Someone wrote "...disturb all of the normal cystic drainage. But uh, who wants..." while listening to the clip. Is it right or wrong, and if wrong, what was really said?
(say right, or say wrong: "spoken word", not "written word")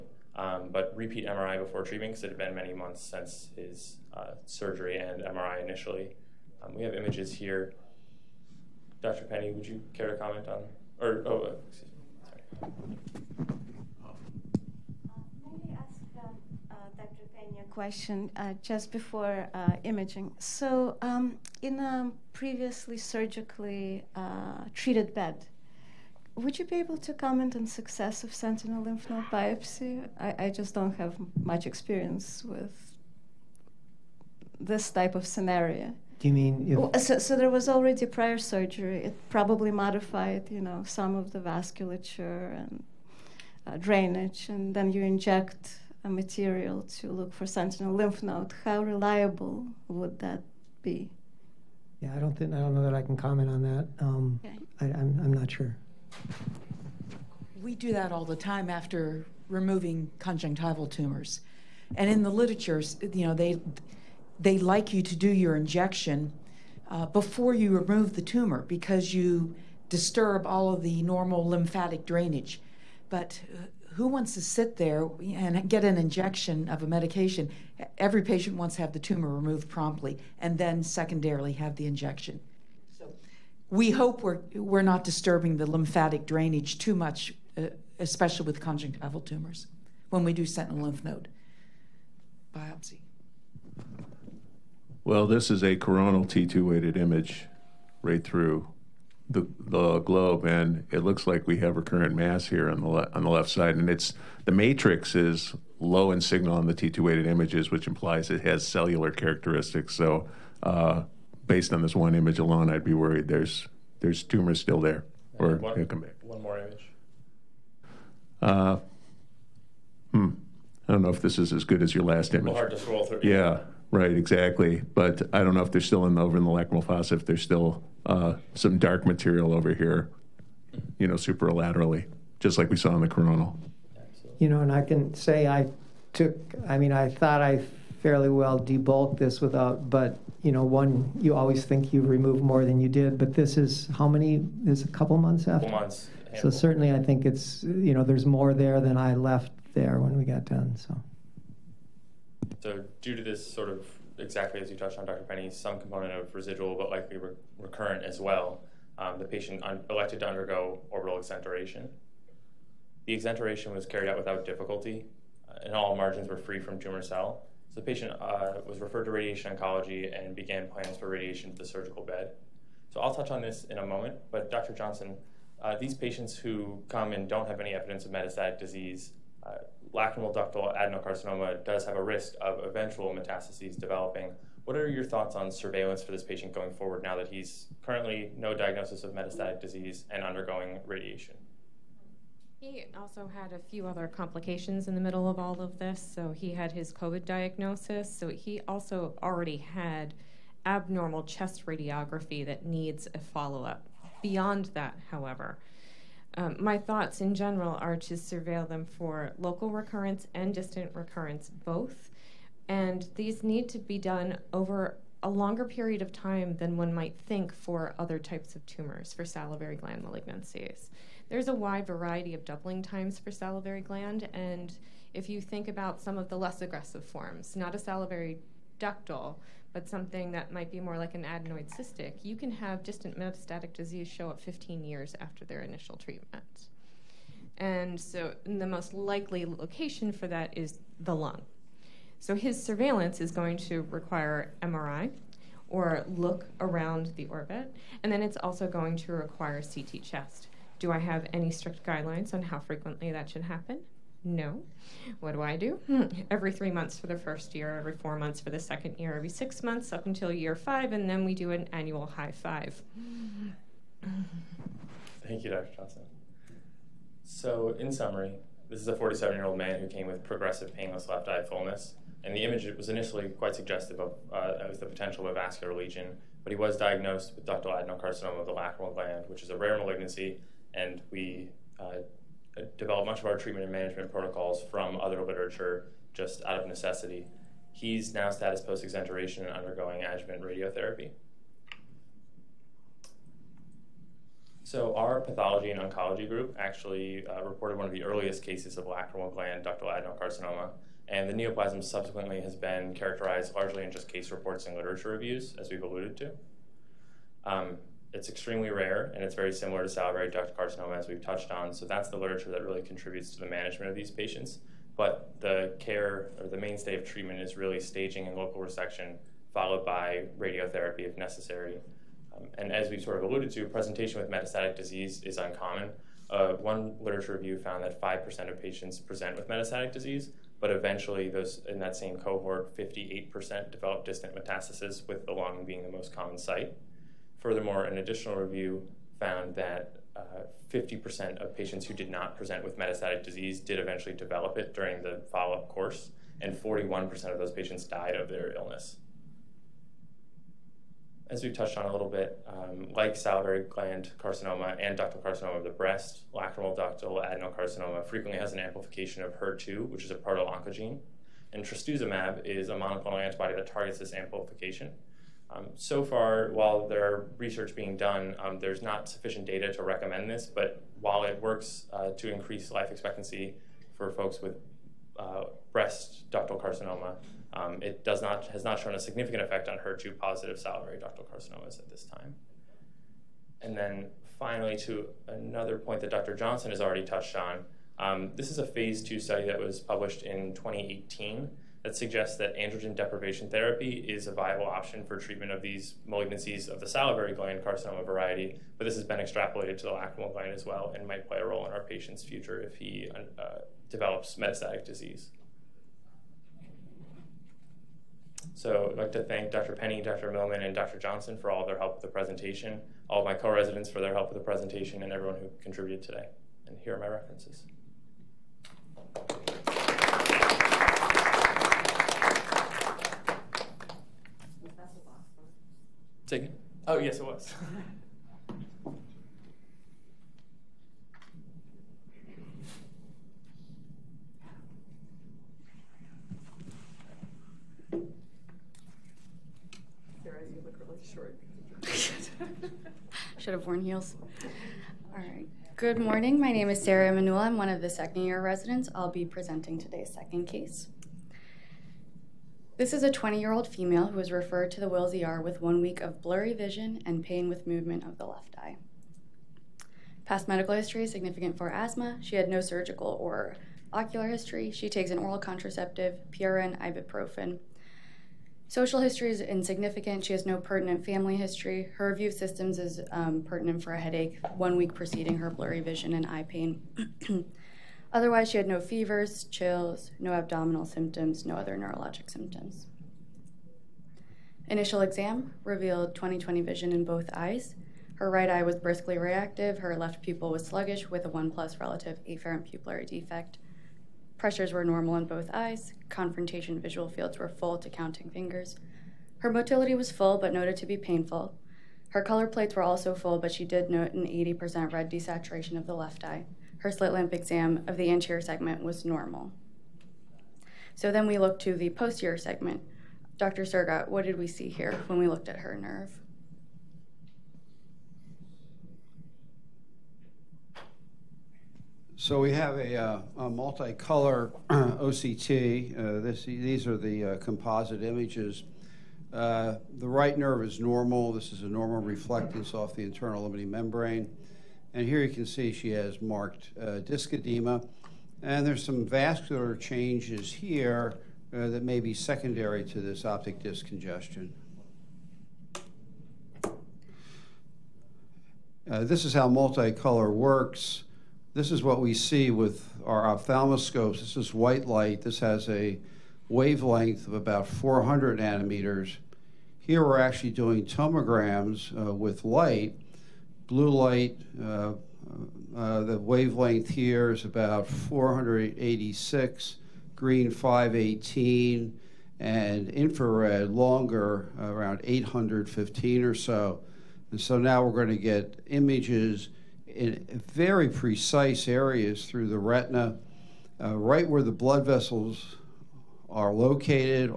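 wrong: "lymphatic", not "cystic".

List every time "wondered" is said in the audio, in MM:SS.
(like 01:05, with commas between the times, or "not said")
not said.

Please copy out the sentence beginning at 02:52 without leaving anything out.
So I'll touch on this in a moment, but Dr.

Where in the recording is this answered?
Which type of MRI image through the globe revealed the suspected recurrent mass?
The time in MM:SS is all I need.
01:35.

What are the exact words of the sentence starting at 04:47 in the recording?
He's now status post exenteration and undergoing adjuvant radiotherapy.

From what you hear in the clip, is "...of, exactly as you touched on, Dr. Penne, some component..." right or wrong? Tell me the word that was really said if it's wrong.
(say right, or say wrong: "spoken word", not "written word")
right.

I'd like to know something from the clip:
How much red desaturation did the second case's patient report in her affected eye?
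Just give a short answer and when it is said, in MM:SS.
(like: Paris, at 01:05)
80%, at 08:24.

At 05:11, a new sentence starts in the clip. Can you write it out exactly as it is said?
So that's the literature that really contributes to the management of these patients.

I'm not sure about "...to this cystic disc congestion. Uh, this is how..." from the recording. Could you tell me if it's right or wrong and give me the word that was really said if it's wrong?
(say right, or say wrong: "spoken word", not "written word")
wrong: "optic", not "cystic".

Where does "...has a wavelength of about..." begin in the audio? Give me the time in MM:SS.
09:15.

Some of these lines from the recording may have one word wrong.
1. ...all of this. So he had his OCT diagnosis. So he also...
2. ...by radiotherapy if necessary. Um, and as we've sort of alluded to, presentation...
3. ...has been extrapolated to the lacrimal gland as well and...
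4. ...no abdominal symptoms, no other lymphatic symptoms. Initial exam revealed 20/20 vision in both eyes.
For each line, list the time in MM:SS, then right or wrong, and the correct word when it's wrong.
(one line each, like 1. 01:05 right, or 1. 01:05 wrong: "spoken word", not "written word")
1. 03:15 wrong: "COVID", not "OCT"
2. 05:19 right
3. 06:38 right
4. 08:00 wrong: "neurologic", not "lymphatic".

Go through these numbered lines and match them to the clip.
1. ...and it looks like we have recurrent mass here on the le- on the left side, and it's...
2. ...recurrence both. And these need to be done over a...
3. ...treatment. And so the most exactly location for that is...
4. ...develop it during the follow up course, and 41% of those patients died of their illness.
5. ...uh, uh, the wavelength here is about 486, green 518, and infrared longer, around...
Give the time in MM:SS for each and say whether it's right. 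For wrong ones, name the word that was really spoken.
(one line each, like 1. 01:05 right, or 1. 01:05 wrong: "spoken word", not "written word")
1. 01:40 right
2. 03:30 right
3. 03:55 wrong: "likely", not "exactly"
4. 05:44 right
5. 09:24 right.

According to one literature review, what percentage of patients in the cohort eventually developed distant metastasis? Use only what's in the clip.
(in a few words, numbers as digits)
58%.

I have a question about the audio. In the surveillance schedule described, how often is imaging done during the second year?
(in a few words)
Every 4 months.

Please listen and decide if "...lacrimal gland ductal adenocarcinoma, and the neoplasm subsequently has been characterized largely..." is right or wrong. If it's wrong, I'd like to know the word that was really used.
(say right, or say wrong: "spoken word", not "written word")
right.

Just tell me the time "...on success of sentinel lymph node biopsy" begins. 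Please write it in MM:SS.
00:27.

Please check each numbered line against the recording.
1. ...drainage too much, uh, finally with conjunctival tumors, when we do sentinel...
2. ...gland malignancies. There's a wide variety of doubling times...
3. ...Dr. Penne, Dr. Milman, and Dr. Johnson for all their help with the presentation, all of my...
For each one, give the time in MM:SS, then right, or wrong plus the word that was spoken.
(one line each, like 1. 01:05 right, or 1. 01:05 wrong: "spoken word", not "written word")
1. 01:26 wrong: "especially", not "finally"
2. 03:39 right
3. 06:49 right.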